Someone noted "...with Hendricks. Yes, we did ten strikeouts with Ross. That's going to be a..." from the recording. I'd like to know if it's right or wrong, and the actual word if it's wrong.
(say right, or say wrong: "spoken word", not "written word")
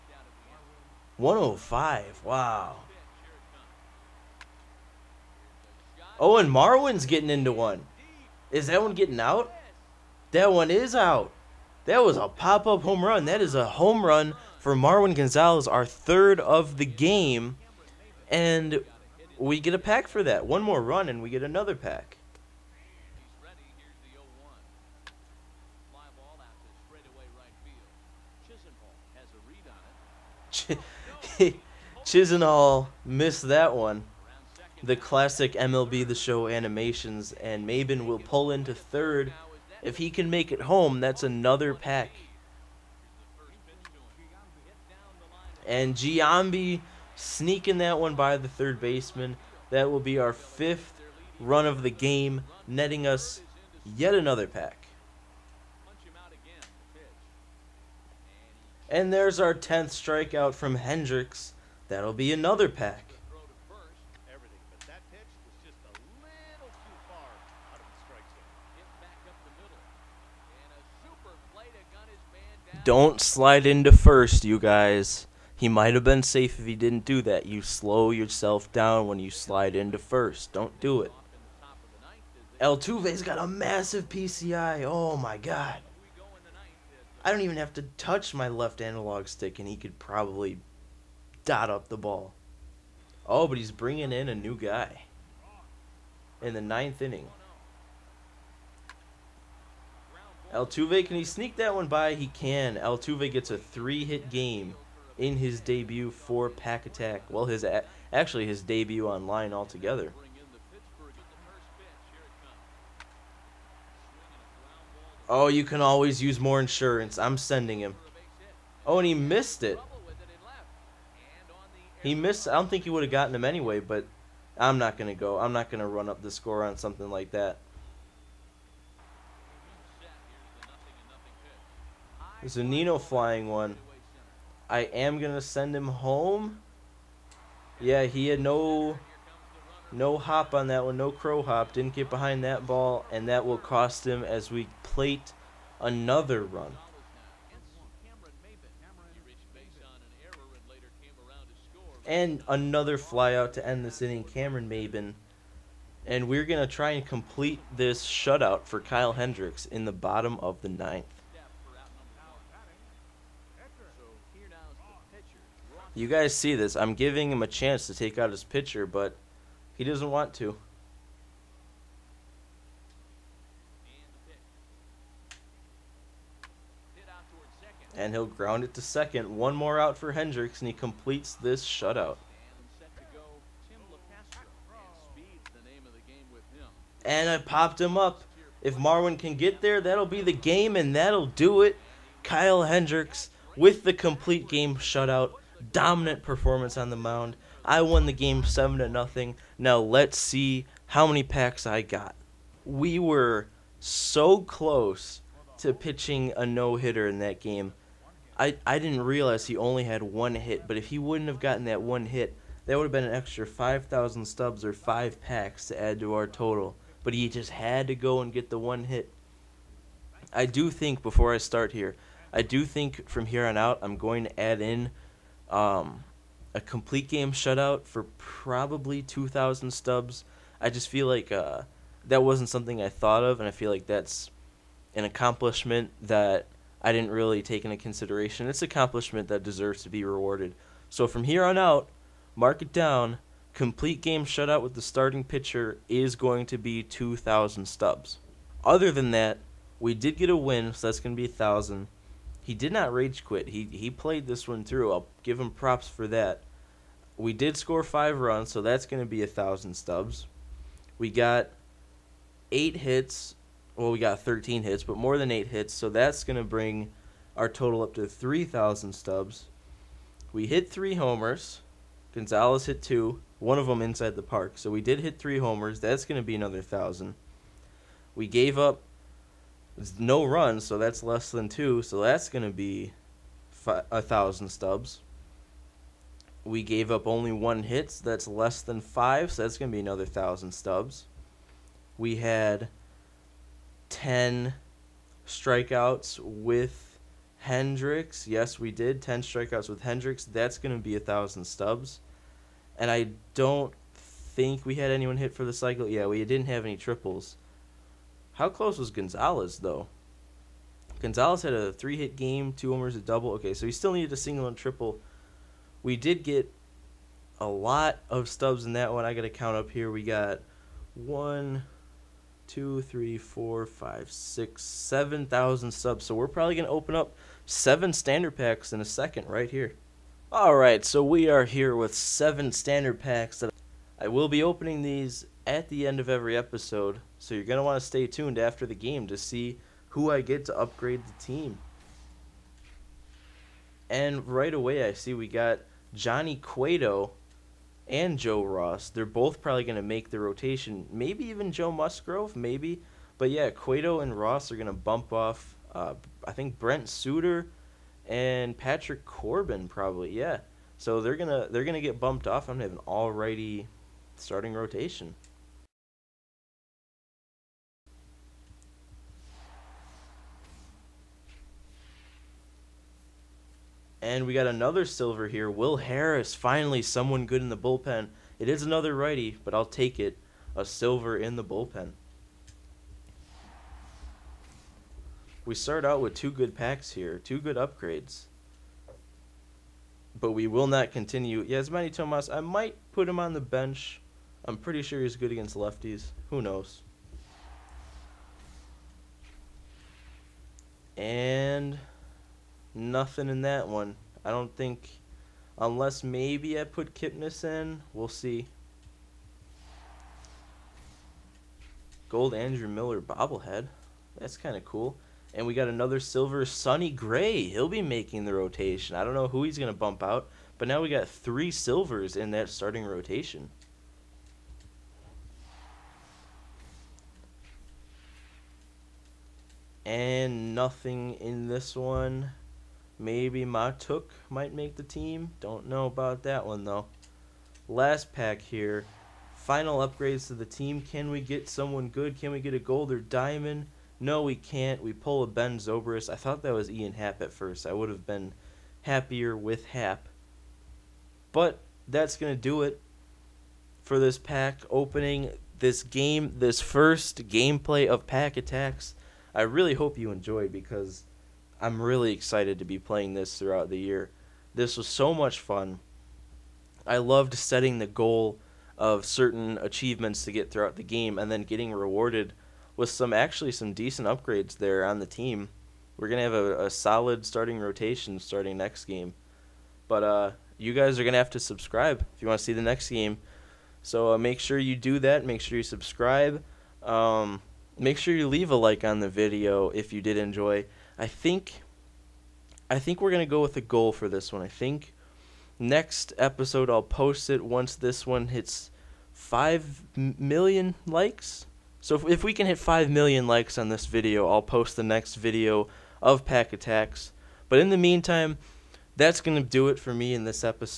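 wrong: "Hendricks", not "Ross".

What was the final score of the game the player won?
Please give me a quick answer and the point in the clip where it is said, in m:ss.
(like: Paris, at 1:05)
7 to 0, at 3:18.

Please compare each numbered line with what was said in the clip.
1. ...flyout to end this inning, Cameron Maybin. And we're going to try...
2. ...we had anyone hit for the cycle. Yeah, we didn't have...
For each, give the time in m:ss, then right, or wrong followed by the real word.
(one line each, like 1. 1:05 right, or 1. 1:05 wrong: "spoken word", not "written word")
1. 2:32 right
2. 5:04 right.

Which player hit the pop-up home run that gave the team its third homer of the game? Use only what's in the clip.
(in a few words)
Marwin Gonzalez.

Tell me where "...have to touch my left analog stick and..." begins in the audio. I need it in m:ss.
1:27.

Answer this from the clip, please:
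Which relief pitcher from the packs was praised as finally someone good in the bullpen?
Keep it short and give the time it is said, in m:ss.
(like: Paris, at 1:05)
Will Harris, at 6:15.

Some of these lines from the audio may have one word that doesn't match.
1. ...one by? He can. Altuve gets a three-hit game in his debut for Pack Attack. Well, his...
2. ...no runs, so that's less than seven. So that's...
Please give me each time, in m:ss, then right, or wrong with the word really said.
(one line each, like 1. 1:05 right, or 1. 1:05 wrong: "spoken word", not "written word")
1. 1:41 right
2. 4:39 wrong: "two", not "seven".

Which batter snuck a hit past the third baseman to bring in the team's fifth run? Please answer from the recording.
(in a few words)
Giambi.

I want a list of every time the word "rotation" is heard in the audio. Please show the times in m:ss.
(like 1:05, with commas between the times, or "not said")
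5:50, 6:04, 6:58, 7:02, 7:57.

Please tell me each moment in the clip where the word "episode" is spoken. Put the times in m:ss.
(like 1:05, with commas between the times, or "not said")
5:36, 8:16.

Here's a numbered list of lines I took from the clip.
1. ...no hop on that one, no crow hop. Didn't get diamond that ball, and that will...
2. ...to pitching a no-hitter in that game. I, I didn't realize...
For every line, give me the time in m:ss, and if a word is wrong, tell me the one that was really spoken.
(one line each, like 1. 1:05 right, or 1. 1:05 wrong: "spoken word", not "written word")
1. 2:19 wrong: "behind", not "diamond"
2. 3:25 right.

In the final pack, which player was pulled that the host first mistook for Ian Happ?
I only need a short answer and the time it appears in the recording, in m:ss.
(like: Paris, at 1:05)
Ben Zobrist, at 7:25.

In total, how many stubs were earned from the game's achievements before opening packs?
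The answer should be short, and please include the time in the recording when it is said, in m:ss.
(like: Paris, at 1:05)
7,000, at 5:24.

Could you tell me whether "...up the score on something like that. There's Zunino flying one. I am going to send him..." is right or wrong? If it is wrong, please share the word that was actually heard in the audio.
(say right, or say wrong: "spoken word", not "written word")
right.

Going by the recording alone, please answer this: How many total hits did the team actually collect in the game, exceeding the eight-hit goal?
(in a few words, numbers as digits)
13.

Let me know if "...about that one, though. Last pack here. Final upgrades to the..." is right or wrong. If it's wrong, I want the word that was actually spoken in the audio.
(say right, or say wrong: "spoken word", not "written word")
right.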